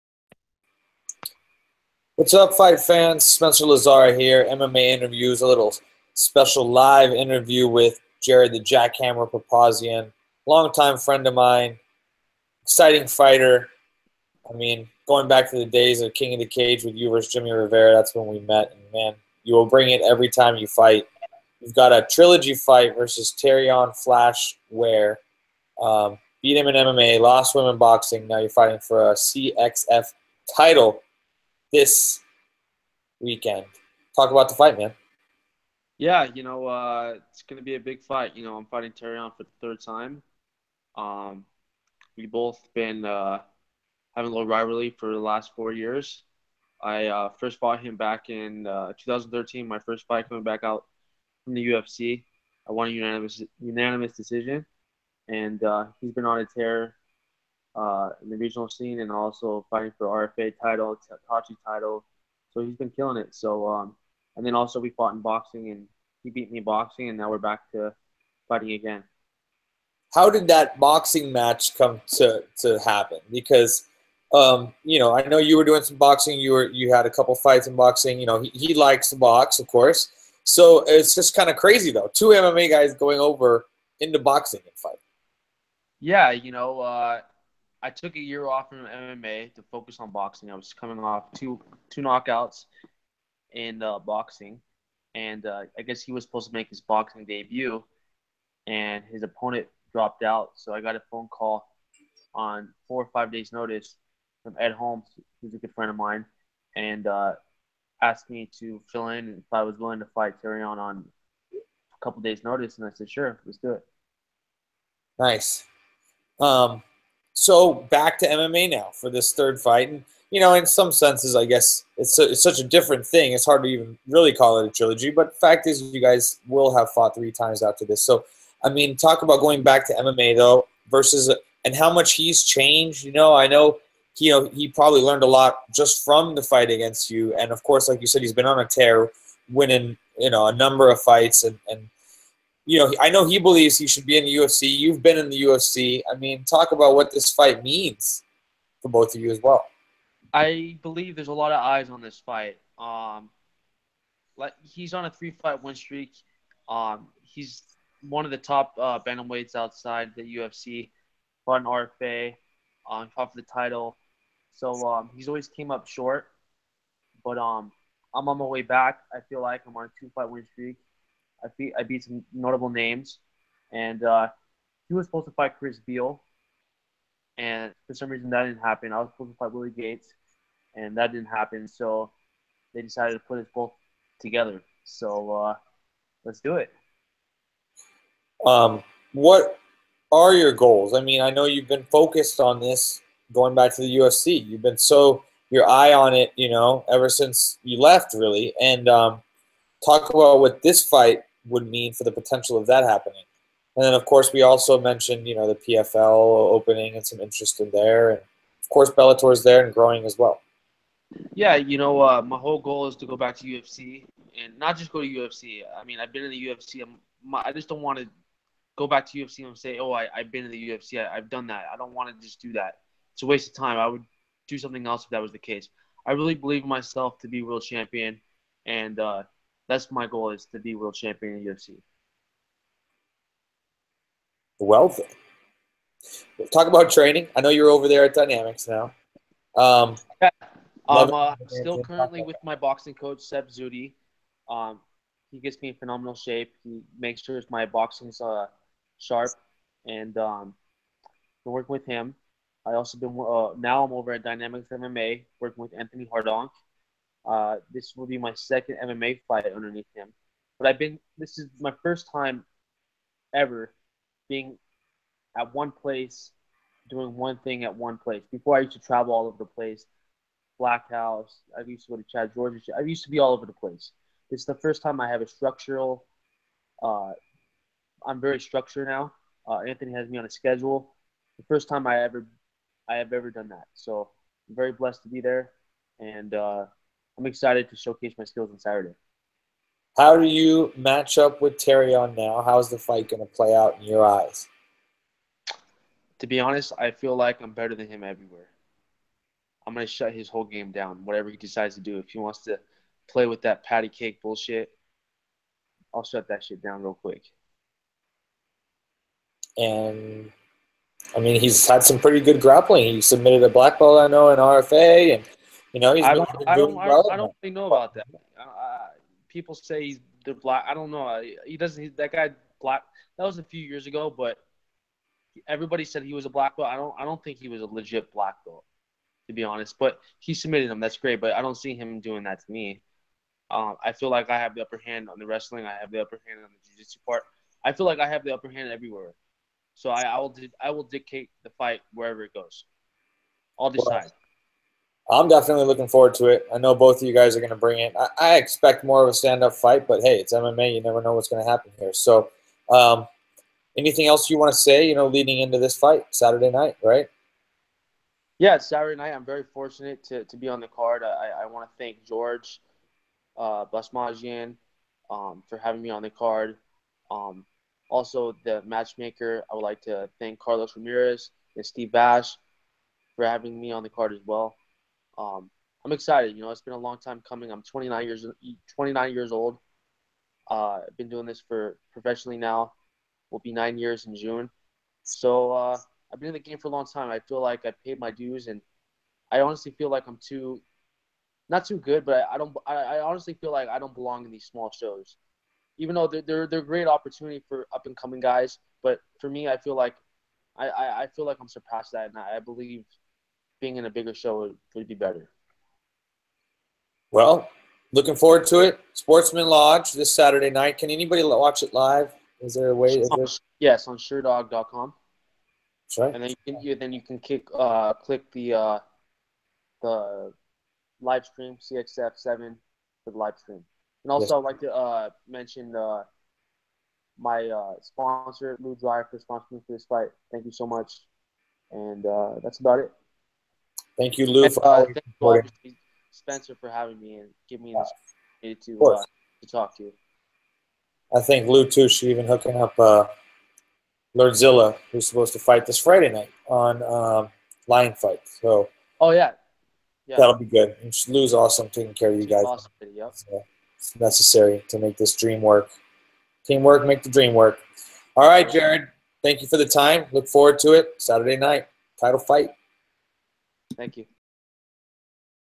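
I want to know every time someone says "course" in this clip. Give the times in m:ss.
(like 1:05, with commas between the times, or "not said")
1:19, 2:17, 3:24, 3:28.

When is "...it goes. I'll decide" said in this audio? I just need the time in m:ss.
5:42.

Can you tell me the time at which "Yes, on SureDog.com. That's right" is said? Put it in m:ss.
6:53.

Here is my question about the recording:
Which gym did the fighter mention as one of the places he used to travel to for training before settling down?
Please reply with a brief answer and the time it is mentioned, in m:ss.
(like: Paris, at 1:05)
Black House, at 4:30.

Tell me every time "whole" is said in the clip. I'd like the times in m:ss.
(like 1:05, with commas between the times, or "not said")
3:32, 5:00.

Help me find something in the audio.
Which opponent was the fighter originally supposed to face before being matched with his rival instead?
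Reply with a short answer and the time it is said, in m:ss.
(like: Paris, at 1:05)
Willie Gates, at 2:59.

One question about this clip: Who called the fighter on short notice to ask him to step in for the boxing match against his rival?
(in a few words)
Ed Holmes.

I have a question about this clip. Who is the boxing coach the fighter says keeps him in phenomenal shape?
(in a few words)
Seb Zudi.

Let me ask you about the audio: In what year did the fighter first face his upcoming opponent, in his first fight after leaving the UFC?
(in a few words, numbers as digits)
2013.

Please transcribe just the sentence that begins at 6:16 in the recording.
You know, it's been a long time coming.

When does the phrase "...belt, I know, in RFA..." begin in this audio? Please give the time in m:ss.
5:13.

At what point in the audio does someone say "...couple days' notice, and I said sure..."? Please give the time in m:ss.
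1:52.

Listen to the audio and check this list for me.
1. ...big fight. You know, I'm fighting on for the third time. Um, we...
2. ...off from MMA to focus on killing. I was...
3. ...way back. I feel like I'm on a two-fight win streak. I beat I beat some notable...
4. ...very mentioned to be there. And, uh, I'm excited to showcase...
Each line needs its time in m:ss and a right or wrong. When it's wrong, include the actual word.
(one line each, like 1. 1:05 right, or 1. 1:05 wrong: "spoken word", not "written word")
1. 0:37 right
2. 1:28 wrong: "boxing", not "killing"
3. 2:48 right
4. 4:44 wrong: "blessed", not "mentioned".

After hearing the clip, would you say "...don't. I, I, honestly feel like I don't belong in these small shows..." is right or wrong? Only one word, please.
right.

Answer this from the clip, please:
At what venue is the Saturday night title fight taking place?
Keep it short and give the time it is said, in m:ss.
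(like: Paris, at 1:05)
Sportsman Lodge, at 6:48.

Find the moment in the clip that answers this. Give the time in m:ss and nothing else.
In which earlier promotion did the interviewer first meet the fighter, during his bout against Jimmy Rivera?
0:16.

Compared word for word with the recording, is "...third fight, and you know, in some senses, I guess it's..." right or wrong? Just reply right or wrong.
right.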